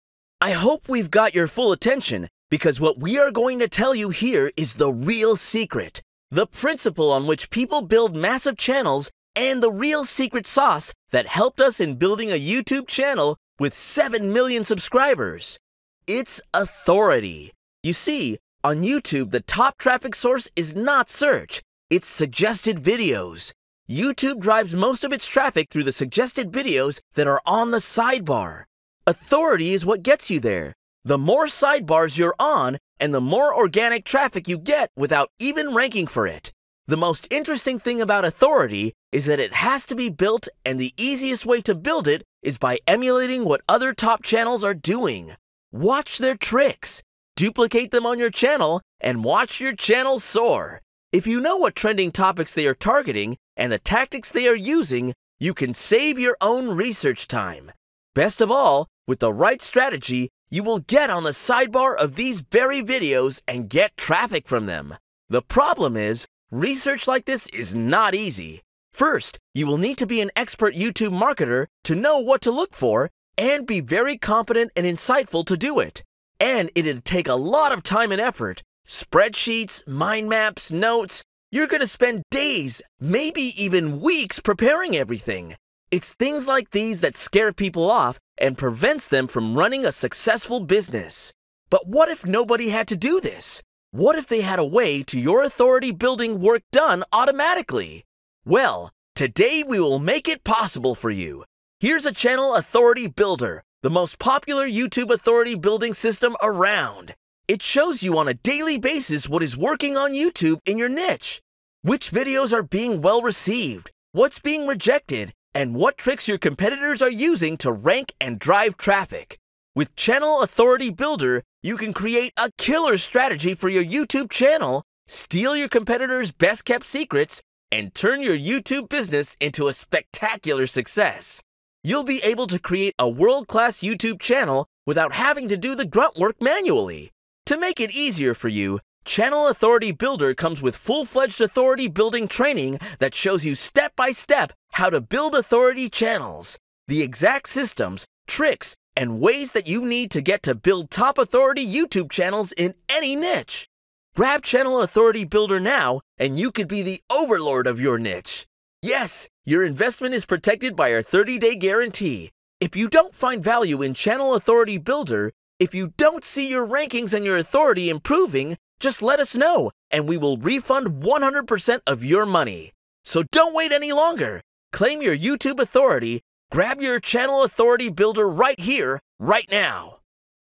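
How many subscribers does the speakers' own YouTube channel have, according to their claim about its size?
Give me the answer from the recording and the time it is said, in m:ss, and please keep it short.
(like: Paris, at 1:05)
7 million, at 0:13.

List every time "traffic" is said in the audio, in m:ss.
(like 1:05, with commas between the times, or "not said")
0:19, 0:25, 0:34, 1:03, 1:58.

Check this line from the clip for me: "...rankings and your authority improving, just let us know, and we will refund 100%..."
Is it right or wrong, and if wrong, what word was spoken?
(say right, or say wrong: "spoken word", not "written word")
right.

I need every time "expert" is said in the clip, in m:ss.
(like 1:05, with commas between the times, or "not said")
1:10.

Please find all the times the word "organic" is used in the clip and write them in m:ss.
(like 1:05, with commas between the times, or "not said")
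0:33.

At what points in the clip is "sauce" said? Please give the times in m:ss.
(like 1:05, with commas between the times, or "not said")
0:10.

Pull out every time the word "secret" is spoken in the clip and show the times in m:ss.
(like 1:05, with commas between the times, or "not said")
0:05, 0:10, 2:06.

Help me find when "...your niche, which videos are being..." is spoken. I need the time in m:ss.
1:50.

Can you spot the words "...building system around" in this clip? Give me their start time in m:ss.
1:45.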